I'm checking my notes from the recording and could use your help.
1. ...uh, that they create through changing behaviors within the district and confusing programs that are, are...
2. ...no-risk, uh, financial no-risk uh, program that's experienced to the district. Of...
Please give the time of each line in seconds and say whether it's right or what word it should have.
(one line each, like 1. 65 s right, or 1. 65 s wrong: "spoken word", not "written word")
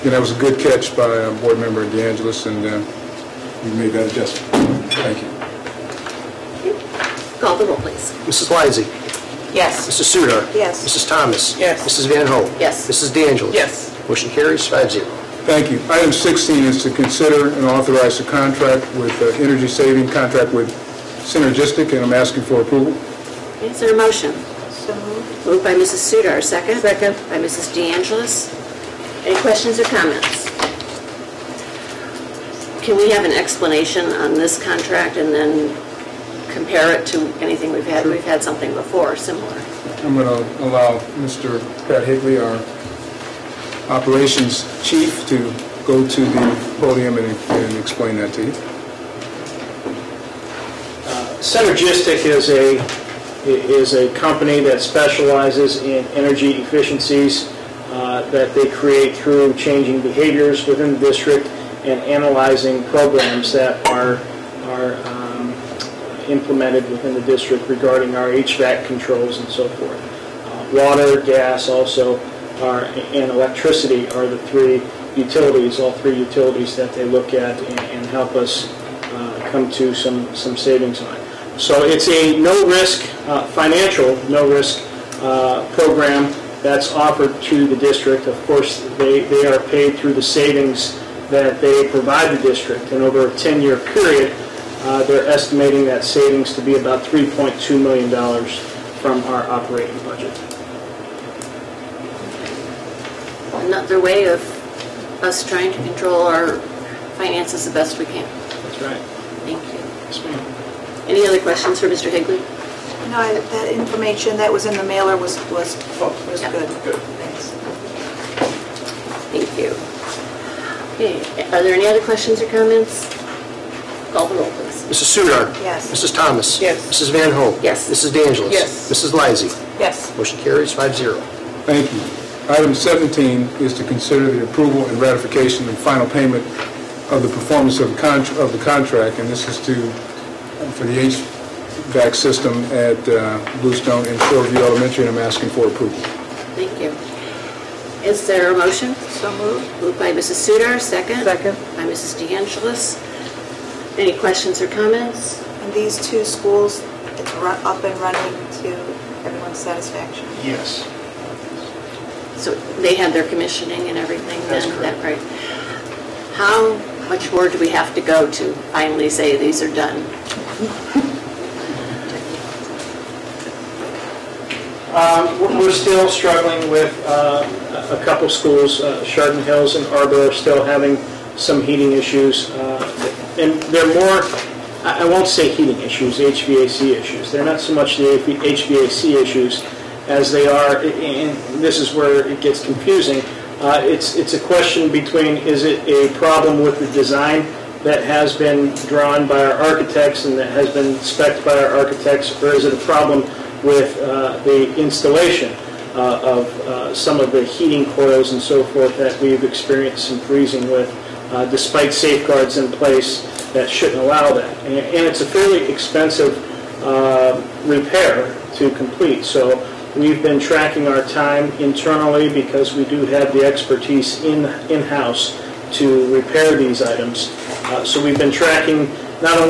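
1. 57 s wrong: "analyzing", not "confusing"
2. 82 s wrong: "offered", not "experienced".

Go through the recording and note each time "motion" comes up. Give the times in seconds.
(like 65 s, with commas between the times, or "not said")
14 s, 23 s, 130 s, 148 s.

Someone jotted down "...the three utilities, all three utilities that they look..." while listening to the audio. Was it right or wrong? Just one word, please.
right.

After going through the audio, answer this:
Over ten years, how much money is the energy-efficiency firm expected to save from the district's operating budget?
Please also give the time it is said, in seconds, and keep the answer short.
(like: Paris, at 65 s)
$3.2 million, at 97 s.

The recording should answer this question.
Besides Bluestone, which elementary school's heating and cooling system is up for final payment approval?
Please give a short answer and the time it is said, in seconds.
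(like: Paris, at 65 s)
Shoreview Elementary, at 144 s.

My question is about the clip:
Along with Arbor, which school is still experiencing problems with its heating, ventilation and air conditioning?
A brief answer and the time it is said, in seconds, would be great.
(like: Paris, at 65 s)
Chardon Hills, at 179 s.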